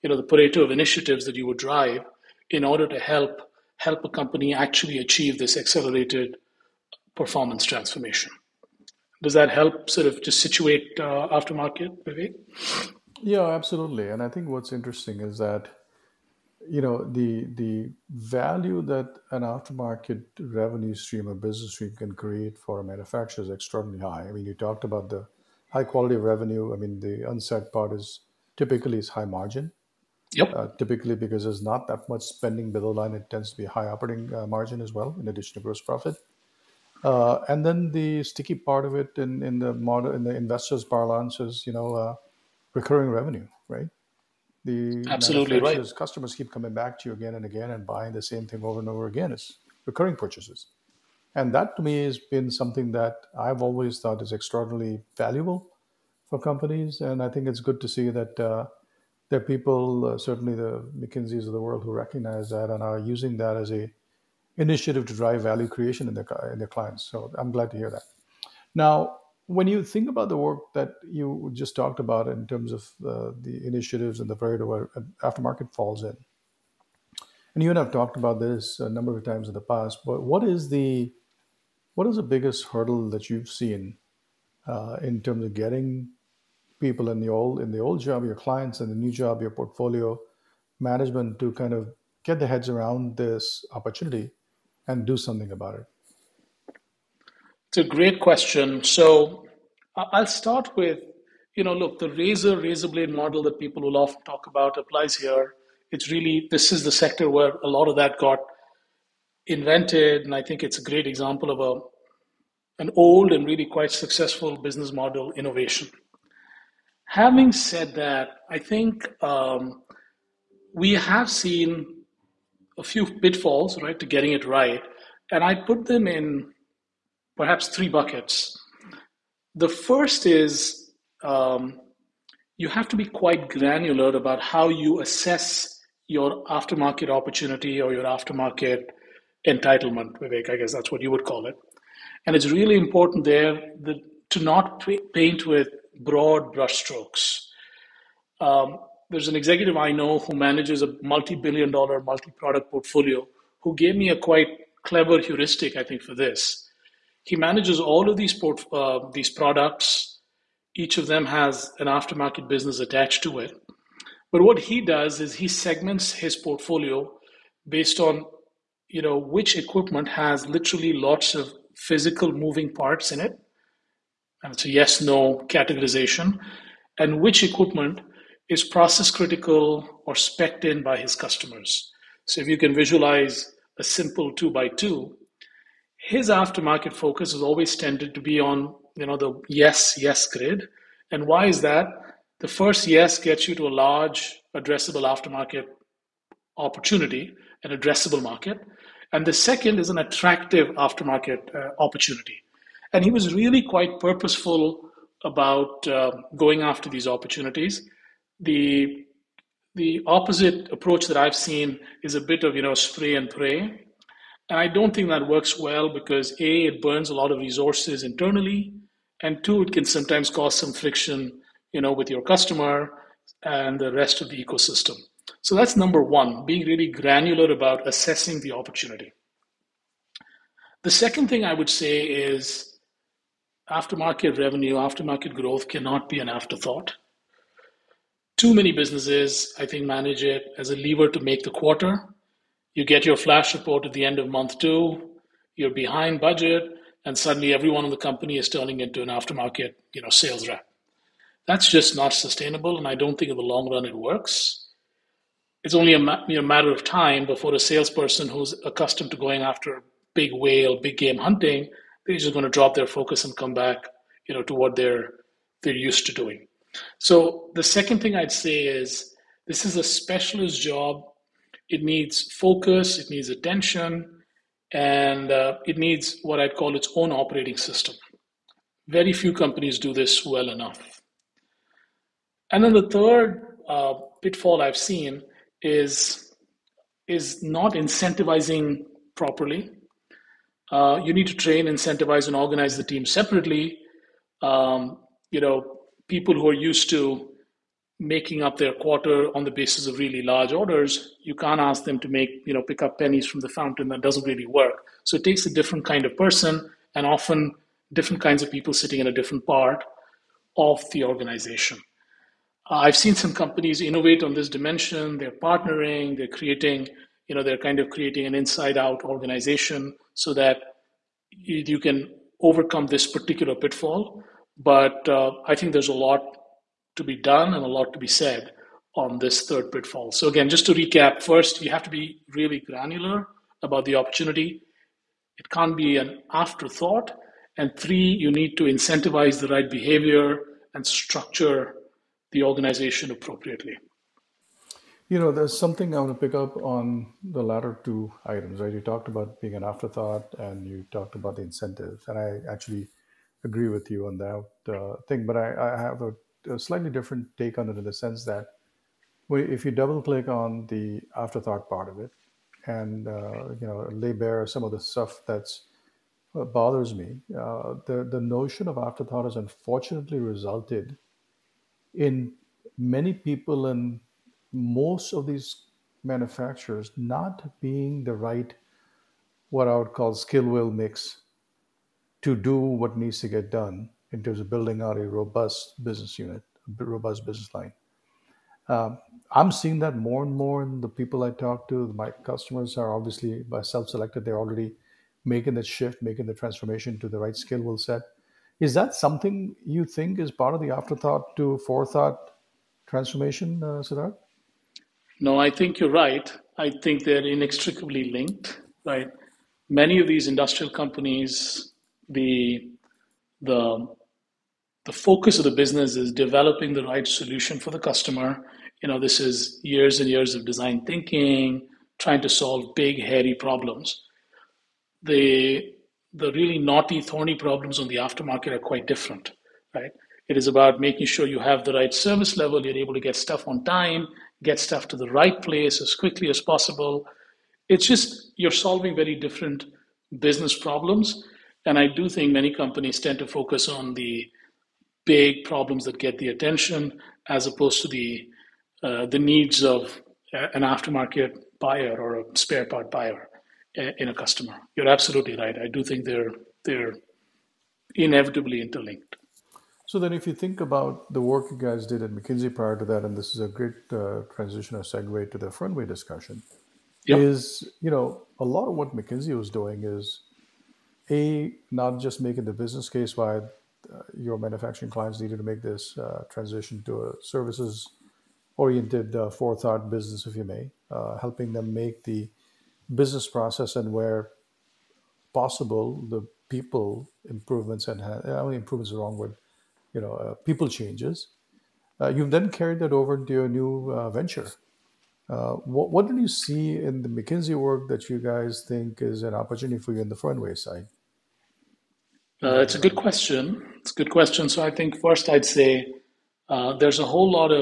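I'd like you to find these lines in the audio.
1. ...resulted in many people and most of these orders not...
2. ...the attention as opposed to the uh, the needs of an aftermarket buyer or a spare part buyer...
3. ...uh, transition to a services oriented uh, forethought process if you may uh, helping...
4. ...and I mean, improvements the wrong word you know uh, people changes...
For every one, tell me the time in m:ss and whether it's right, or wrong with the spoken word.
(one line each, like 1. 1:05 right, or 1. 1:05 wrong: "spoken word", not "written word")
1. 6:10 wrong: "manufacturers", not "orders"
2. 7:26 right
3. 7:55 wrong: "business", not "process"
4. 8:07 right.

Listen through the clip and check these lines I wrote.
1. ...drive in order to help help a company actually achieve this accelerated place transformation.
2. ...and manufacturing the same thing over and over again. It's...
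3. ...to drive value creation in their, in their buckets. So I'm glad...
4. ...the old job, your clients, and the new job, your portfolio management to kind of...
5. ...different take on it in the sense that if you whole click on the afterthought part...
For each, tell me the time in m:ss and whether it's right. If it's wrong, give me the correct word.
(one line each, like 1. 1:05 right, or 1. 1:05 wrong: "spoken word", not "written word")
1. 0:01 wrong: "performance", not "place"
2. 0:47 wrong: "buying", not "manufacturing"
3. 1:05 wrong: "clients", not "buckets"
4. 1:27 right
5. 5:56 wrong: "double", not "whole".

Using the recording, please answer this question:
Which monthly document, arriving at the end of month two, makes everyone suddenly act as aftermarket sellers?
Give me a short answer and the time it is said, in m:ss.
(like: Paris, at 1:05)
flash report, at 4:03.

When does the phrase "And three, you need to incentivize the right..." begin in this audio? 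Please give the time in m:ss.
5:37.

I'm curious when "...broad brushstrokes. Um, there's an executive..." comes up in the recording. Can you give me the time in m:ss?
2:26.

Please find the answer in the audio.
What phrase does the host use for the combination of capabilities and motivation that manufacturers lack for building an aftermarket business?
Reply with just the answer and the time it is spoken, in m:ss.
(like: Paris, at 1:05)
skill will mix, at 6:20.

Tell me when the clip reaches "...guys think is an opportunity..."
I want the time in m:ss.
8:18.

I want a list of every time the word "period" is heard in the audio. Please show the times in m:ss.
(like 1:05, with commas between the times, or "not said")
1:14.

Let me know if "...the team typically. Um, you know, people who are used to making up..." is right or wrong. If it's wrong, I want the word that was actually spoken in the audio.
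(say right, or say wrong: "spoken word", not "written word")
wrong: "separately", not "typically".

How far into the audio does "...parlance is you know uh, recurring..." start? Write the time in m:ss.
0:40.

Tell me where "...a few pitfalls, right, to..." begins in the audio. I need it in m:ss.
2:02.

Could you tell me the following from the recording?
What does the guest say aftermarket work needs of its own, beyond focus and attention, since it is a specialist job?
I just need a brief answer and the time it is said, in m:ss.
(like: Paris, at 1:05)
its own operating system, at 4:36.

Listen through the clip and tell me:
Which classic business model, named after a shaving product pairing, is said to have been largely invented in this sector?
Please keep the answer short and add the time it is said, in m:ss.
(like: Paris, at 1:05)
razor razor blade model, at 1:42.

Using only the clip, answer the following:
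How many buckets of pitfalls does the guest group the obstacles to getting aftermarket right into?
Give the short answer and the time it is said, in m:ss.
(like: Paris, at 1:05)
3, at 2:07.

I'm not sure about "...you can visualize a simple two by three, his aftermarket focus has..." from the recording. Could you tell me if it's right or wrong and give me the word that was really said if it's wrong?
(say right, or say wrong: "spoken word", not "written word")
wrong: "two", not "three".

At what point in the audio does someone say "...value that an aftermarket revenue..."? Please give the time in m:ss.
0:18.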